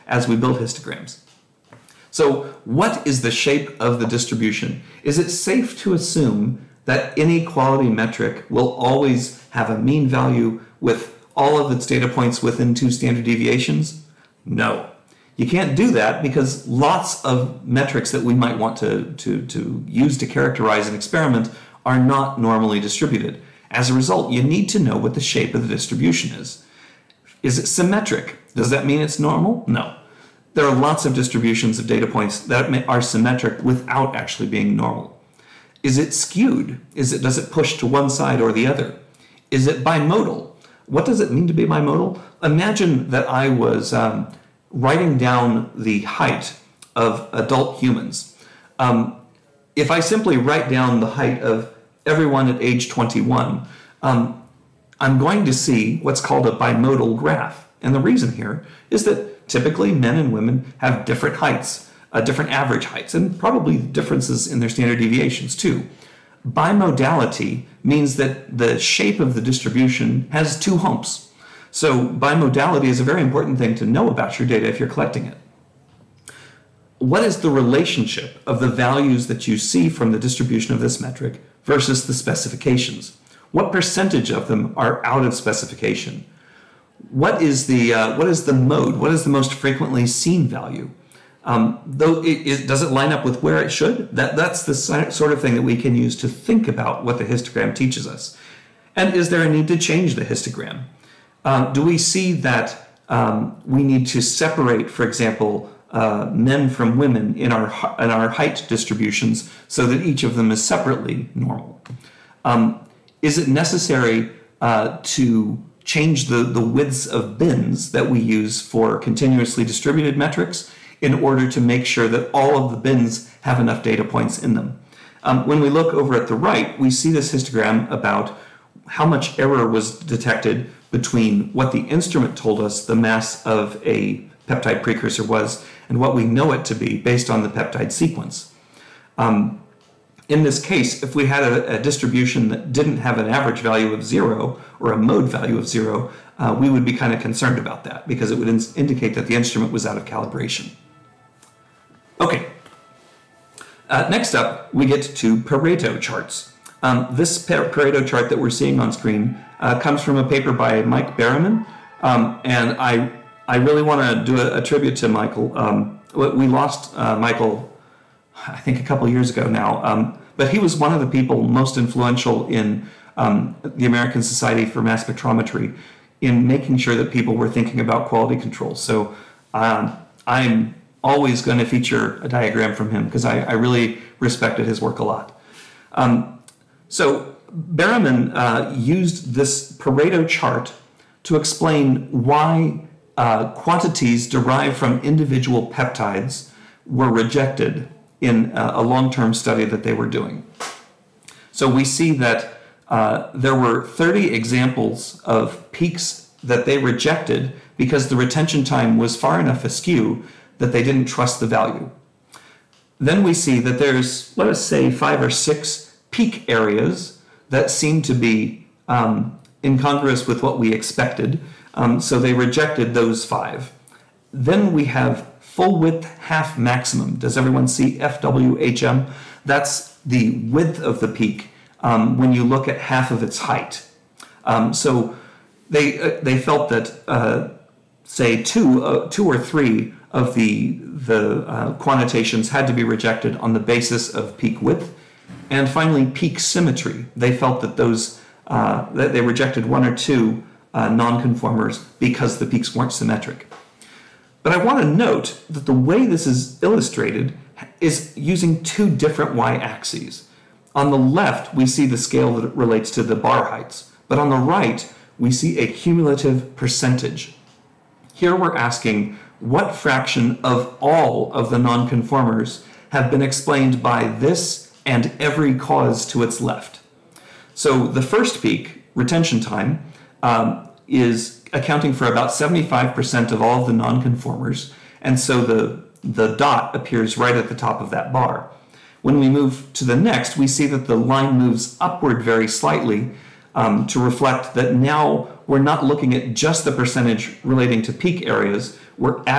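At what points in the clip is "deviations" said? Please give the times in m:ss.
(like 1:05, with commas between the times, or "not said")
0:13, 1:04.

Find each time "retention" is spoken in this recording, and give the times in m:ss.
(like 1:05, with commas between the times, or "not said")
3:28, 4:38.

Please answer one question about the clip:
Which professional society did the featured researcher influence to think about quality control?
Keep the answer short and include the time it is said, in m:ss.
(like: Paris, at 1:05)
American Society for Mass Spectrometry, at 2:53.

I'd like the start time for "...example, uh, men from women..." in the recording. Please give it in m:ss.
1:45.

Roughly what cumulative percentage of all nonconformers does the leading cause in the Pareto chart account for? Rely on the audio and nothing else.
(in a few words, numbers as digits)
75%.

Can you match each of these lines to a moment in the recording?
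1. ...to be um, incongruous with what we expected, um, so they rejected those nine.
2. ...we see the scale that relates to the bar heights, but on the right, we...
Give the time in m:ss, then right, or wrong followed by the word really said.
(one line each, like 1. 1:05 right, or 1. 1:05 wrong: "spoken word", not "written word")
1. 3:38 wrong: "five", not "nine"
2. 4:21 right.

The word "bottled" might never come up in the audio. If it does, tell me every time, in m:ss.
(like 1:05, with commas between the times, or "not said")
not said.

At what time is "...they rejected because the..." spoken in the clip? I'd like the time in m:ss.
3:26.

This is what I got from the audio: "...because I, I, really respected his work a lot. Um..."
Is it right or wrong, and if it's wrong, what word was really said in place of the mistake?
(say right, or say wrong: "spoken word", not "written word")
right.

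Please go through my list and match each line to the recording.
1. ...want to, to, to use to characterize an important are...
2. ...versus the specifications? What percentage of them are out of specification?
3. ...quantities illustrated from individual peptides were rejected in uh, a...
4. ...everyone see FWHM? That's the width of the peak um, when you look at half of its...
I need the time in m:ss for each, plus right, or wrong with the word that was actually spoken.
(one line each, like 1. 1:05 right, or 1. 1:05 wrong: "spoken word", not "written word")
1. 0:18 wrong: "experiment", not "important"
2. 1:21 right
3. 3:13 wrong: "derived", not "illustrated"
4. 3:47 right.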